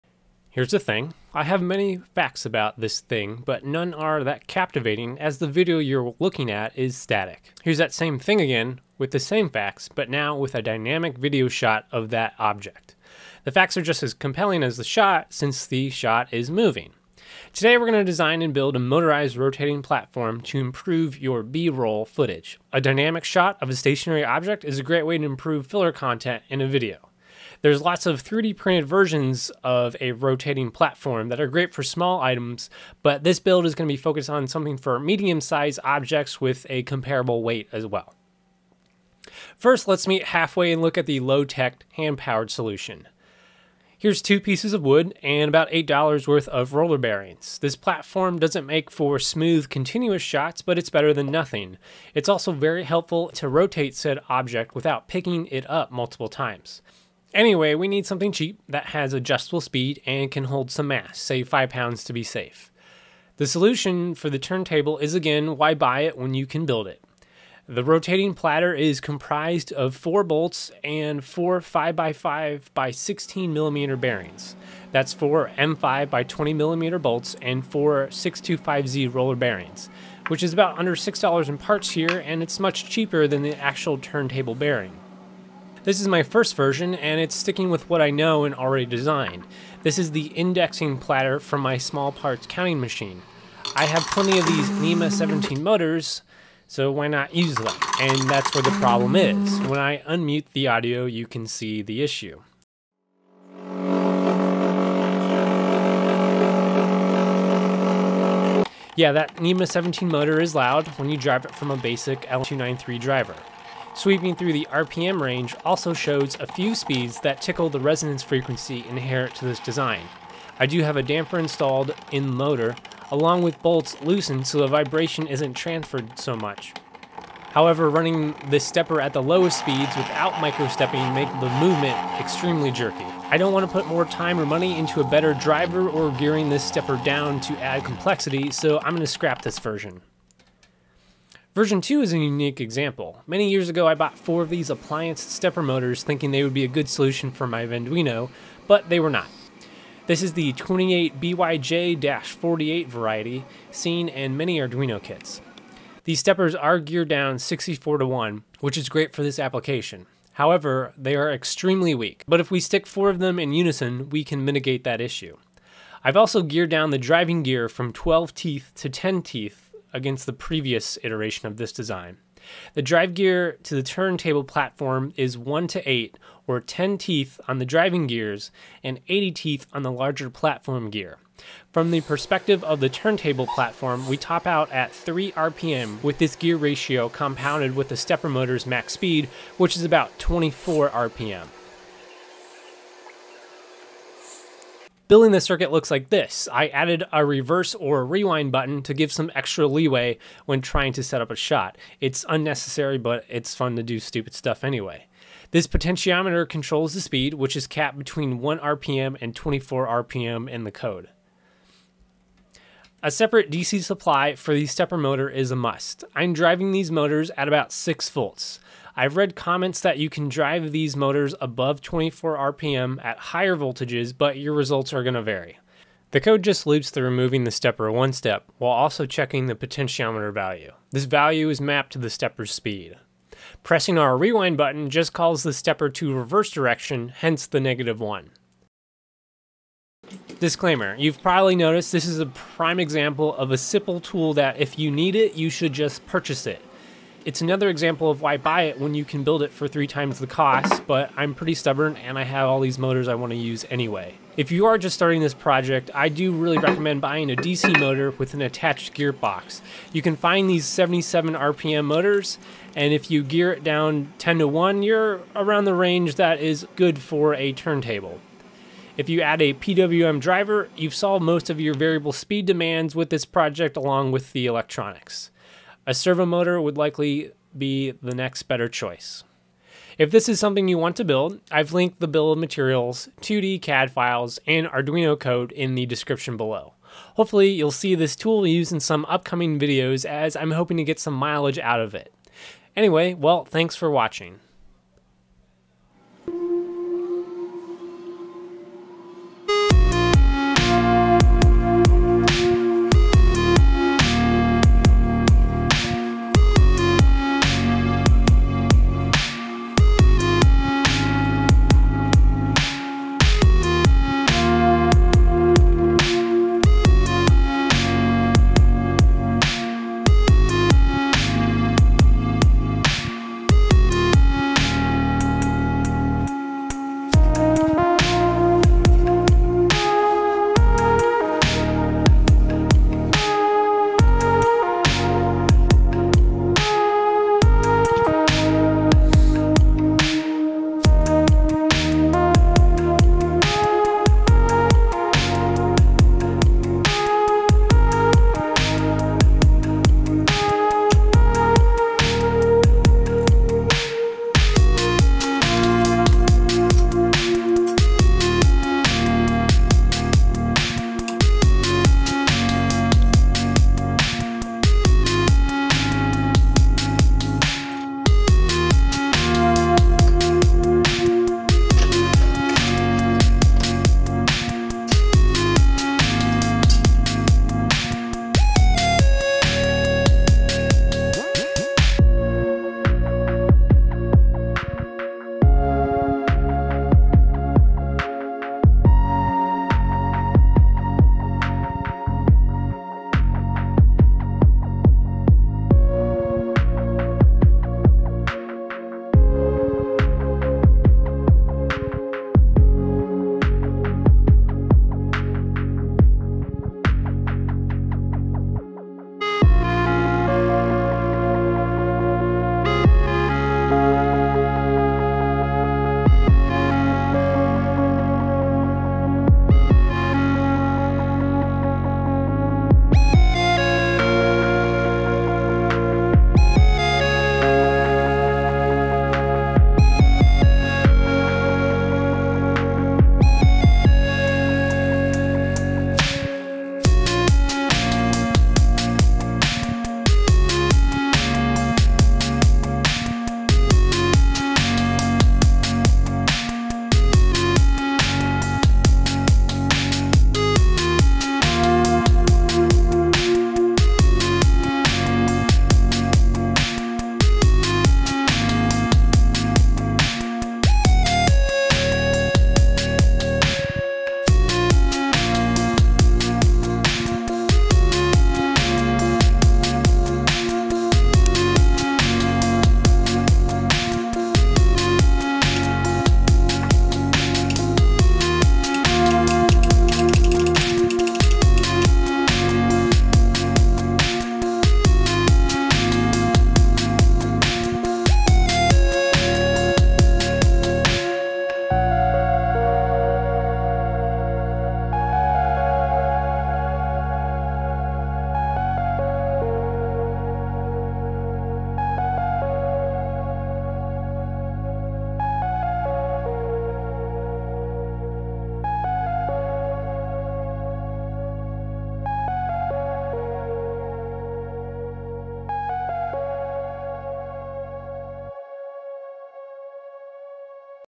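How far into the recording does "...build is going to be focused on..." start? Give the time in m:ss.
0:33.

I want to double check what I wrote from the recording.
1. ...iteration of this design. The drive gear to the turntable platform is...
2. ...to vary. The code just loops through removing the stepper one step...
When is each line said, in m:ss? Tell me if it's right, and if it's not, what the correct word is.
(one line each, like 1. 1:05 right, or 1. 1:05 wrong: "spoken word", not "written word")
1. 2:51 right
2. 3:45 right.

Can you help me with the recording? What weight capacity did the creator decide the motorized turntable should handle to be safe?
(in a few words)
5 pounds.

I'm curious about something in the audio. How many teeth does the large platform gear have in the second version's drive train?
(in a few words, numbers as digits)
80.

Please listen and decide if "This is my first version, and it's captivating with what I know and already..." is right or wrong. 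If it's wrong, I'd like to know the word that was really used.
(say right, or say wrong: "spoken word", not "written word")
wrong: "sticking", not "captivating".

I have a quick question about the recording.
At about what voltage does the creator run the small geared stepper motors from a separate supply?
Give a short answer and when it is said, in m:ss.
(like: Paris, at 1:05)
6 volts, at 3:37.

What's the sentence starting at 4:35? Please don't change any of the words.
A servo motor would likely be the next better choice.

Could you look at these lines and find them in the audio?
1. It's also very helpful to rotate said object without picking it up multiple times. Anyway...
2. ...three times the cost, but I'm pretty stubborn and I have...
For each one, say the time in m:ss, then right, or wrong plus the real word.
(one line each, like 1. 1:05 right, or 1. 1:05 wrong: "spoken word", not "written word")
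1. 0:52 right
2. 4:09 right.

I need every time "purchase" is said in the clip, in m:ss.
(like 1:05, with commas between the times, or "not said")
4:06.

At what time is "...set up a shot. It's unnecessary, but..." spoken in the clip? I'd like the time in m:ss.
3:21.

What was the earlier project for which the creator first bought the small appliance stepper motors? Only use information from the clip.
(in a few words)
Venduino.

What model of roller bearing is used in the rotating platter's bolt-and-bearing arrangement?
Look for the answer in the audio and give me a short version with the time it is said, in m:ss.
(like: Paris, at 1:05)
625Z, at 1:18.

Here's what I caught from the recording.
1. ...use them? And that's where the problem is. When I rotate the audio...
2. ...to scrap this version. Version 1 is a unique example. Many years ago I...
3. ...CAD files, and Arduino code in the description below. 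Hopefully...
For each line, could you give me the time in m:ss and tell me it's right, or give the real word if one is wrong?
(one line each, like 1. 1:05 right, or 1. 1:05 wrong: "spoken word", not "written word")
1. 1:37 wrong: "unmute", not "rotate"
2. 2:19 wrong: "2", not "1"
3. 4:43 right.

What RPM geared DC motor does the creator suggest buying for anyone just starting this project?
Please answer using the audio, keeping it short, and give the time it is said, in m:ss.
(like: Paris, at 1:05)
77 RPM, at 4:20.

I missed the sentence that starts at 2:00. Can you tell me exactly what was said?
I do have a damper installed in motor, along with bolts loosened so the vibration isn't transferred so much.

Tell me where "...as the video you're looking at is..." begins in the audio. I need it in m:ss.
0:05.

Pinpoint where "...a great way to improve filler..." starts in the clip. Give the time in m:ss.
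0:24.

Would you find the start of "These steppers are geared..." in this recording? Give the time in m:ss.
2:36.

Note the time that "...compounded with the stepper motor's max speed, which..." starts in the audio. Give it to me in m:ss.
3:07.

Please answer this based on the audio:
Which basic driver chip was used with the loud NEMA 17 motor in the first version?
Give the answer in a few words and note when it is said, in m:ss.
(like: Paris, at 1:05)
L293, at 1:52.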